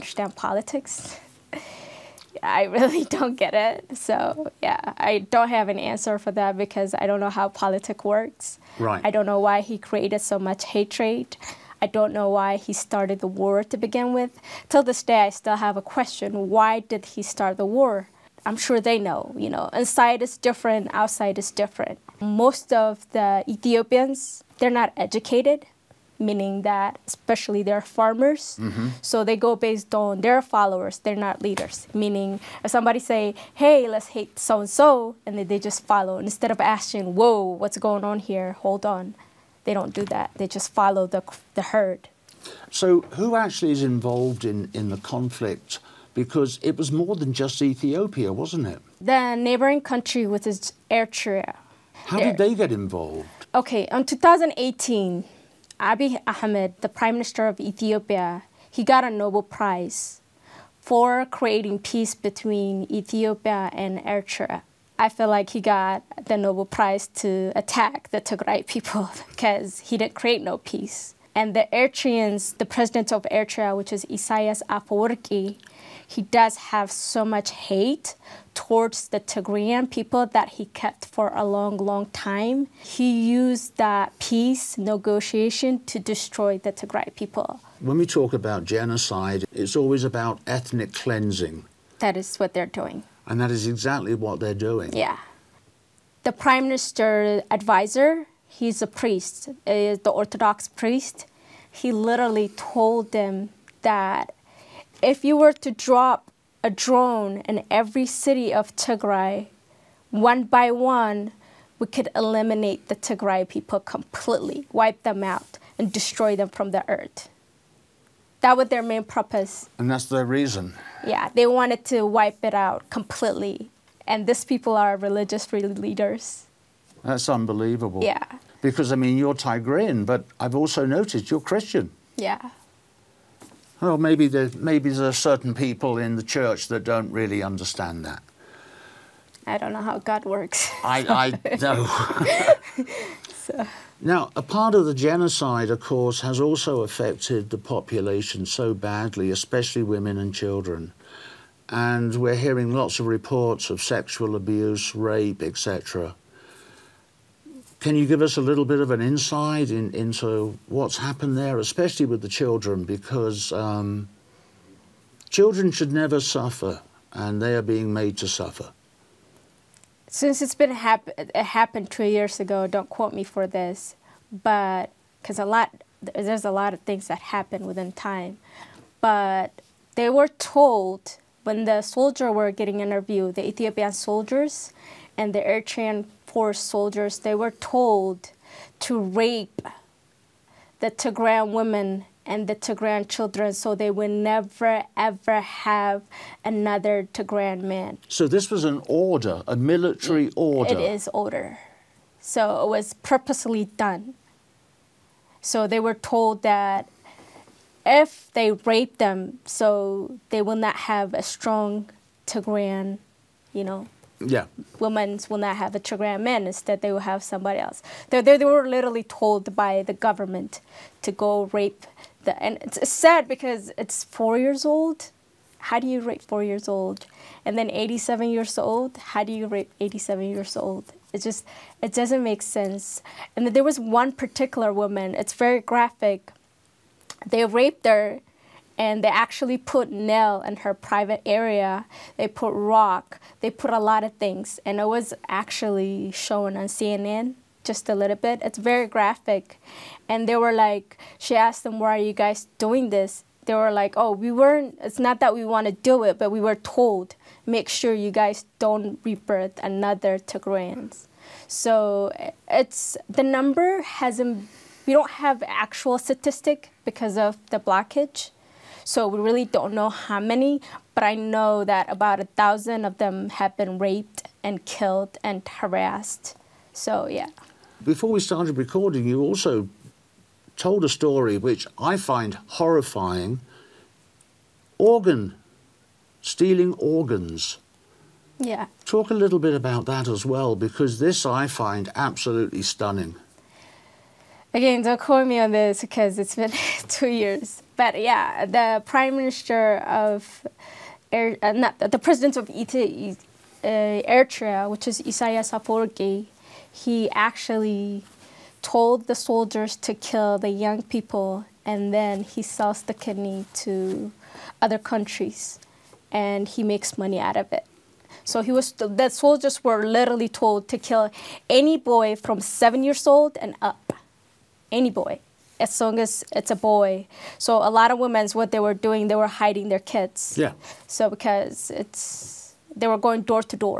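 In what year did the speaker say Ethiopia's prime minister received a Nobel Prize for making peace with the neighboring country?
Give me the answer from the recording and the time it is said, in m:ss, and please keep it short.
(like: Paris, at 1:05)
2018, at 0:54.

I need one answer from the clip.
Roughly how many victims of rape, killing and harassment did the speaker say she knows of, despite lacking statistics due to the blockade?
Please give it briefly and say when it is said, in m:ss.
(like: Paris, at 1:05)
about 1,000, at 4:31.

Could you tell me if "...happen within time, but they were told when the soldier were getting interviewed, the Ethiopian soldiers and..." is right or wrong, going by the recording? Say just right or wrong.
right.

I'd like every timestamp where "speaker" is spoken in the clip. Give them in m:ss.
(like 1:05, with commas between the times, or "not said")
not said.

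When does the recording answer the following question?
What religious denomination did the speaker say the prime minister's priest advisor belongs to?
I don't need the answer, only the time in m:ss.
1:40.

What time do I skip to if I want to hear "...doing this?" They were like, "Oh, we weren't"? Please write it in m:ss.
4:12.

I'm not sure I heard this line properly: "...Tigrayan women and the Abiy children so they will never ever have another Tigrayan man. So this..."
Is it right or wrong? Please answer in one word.
wrong.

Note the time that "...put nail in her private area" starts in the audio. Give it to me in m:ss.
3:59.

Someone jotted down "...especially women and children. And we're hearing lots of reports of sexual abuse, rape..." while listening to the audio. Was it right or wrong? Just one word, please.
right.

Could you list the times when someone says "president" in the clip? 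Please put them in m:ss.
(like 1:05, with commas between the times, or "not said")
1:12, 5:01.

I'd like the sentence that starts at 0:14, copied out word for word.
Till this day, I still have a question why did he start the war?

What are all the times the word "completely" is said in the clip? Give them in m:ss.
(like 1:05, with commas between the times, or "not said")
1:53, 2:02.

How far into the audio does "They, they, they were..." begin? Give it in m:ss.
3:38.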